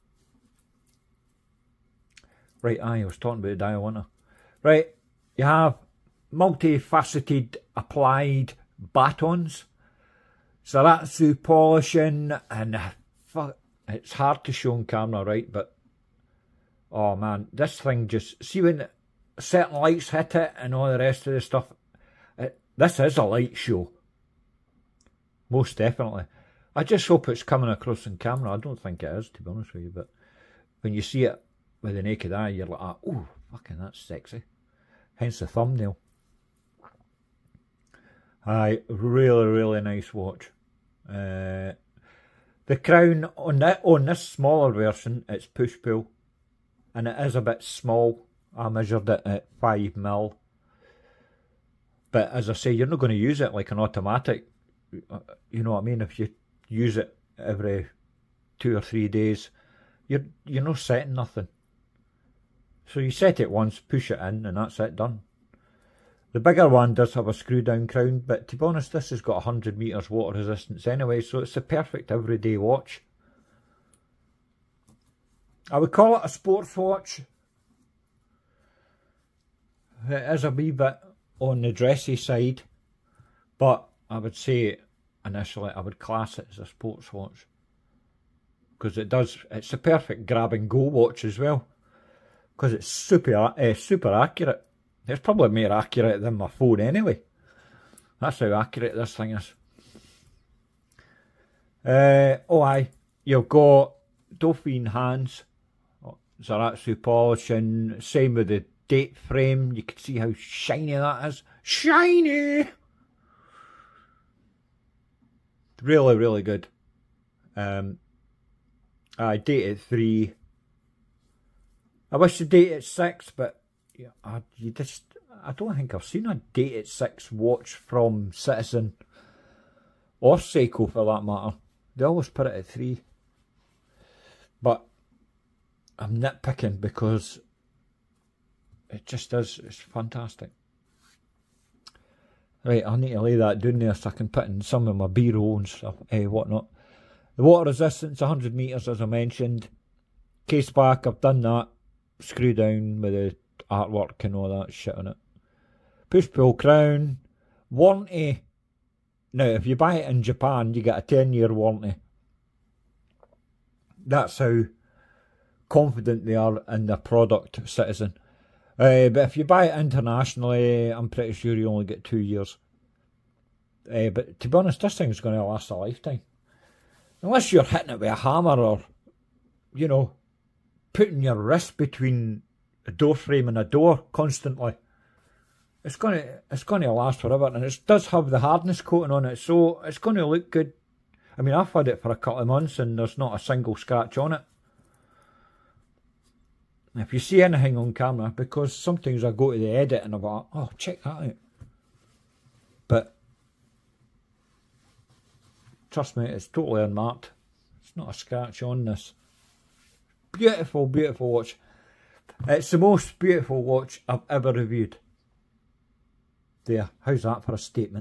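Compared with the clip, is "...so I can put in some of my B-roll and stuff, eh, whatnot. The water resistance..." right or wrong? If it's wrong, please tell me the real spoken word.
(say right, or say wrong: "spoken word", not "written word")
right.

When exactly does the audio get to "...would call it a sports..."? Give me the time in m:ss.
1:15.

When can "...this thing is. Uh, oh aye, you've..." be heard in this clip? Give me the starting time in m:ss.
1:38.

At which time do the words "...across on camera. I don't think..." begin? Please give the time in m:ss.
0:27.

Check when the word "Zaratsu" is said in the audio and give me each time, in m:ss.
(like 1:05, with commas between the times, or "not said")
0:10, 1:46.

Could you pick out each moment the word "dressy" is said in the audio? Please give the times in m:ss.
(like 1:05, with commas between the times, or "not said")
1:21.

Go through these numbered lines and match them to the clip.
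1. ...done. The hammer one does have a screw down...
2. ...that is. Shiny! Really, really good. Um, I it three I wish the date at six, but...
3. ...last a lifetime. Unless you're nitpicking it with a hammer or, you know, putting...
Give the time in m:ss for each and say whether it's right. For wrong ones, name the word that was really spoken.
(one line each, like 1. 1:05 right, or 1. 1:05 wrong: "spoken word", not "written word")
1. 1:04 wrong: "bigger", not "hammer"
2. 1:50 right
3. 2:55 wrong: "hitting", not "nitpicking".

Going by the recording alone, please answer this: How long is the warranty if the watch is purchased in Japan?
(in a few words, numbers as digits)
10 years.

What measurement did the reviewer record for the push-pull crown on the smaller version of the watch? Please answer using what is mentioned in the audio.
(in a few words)
5 mm.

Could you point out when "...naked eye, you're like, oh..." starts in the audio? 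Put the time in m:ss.
0:32.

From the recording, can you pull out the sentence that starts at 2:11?
They always put it at three.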